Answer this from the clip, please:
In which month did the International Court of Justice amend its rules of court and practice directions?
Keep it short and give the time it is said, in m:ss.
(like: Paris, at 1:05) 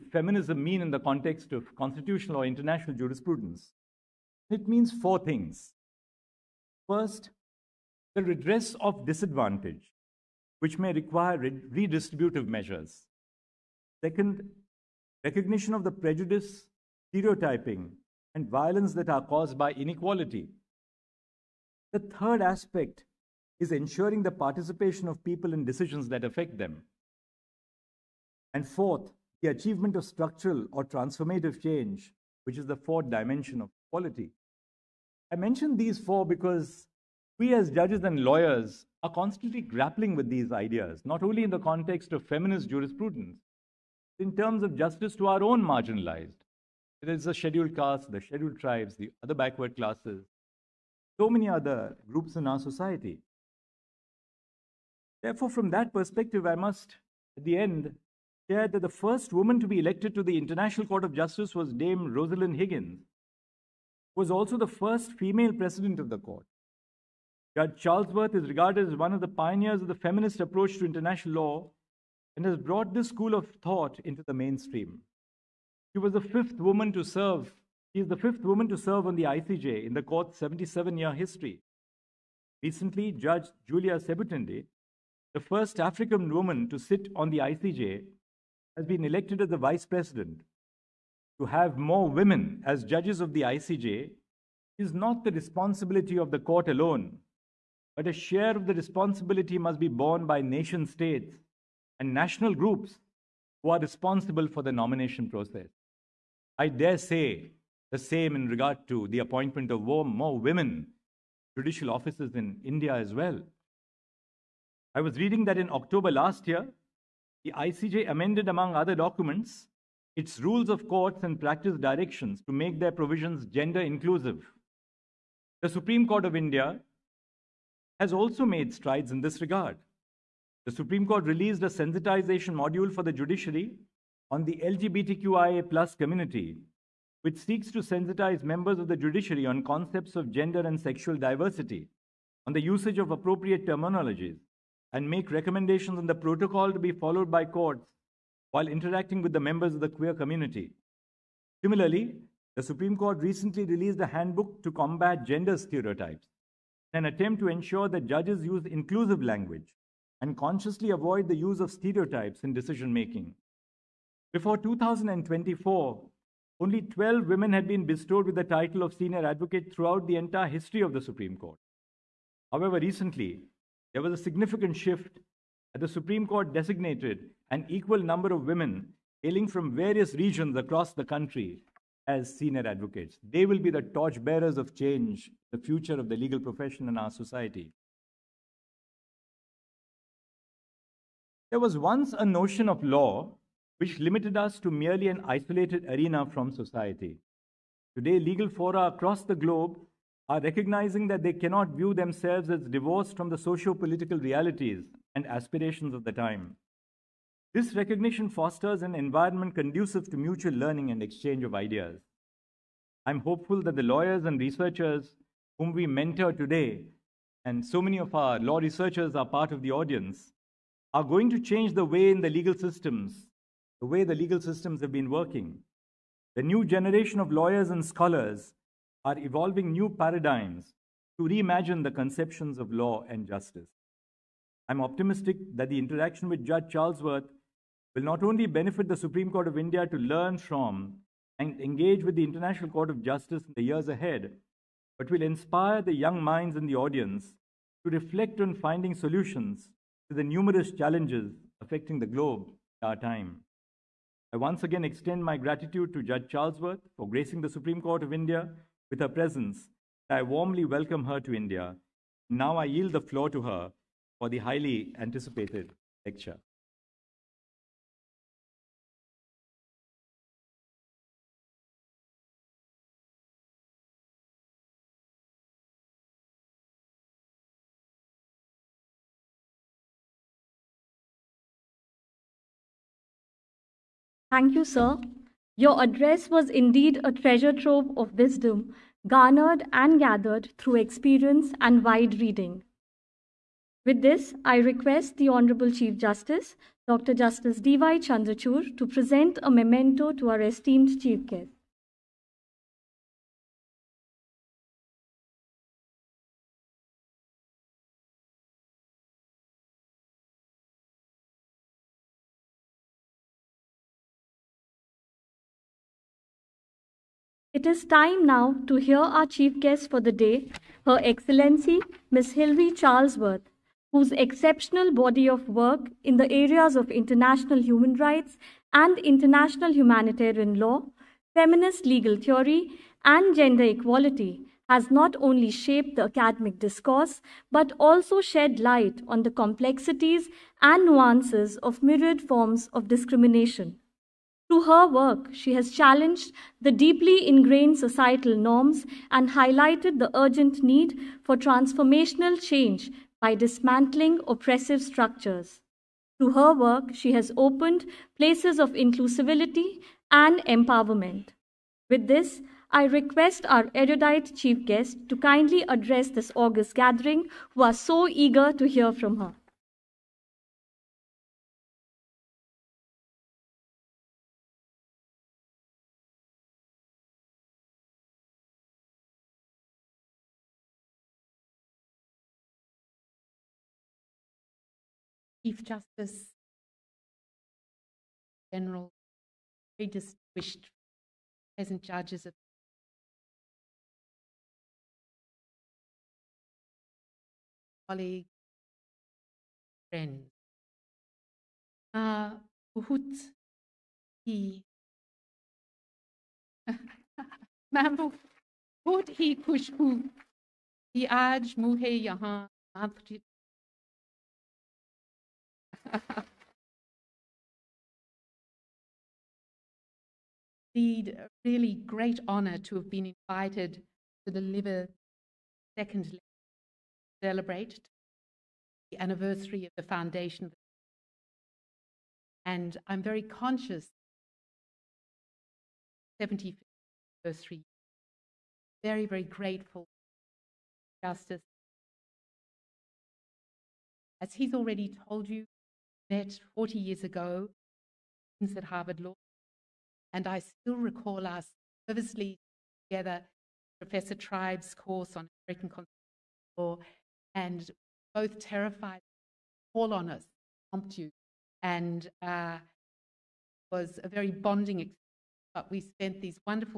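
October, at 1:55.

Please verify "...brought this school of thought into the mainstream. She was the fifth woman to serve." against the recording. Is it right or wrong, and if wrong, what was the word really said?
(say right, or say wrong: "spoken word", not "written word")
right.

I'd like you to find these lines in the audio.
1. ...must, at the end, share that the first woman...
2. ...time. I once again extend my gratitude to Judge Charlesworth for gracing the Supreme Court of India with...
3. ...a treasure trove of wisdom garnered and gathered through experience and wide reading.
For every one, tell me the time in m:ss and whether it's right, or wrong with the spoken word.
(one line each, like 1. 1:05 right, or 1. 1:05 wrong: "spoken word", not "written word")
1. 0:56 right
2. 4:12 right
3. 4:47 right.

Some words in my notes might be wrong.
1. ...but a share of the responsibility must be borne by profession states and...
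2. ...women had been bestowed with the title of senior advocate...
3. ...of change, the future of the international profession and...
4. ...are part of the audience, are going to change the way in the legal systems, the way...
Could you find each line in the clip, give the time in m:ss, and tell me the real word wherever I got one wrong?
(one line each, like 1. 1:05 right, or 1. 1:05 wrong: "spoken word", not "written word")
1. 1:37 wrong: "nation", not "profession"
2. 2:47 right
3. 3:04 wrong: "legal", not "international"
4. 3:39 right.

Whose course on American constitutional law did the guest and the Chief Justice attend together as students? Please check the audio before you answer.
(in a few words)
Professor Tribe.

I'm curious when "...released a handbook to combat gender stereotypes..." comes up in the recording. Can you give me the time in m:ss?
2:33.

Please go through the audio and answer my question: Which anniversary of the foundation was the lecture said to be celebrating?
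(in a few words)
75th.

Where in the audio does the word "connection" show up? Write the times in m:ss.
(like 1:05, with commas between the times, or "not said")
not said.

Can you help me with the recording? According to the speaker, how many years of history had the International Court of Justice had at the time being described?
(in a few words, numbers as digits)
77.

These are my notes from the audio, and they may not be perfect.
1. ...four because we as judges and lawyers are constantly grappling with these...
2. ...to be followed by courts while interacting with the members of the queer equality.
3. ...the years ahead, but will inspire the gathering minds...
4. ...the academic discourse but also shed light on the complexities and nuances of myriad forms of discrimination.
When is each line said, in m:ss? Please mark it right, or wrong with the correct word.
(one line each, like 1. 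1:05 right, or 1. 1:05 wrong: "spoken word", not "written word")
1. 0:35 right
2. 2:26 wrong: "community", not "equality"
3. 4:03 wrong: "young", not "gathering"
4. 5:35 right.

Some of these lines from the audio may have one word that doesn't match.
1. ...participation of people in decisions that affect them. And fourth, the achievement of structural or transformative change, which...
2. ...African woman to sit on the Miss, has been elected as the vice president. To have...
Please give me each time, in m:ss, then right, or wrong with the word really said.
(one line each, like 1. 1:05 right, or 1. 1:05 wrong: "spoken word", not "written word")
1. 0:24 right
2. 1:25 wrong: "ICJ", not "Miss".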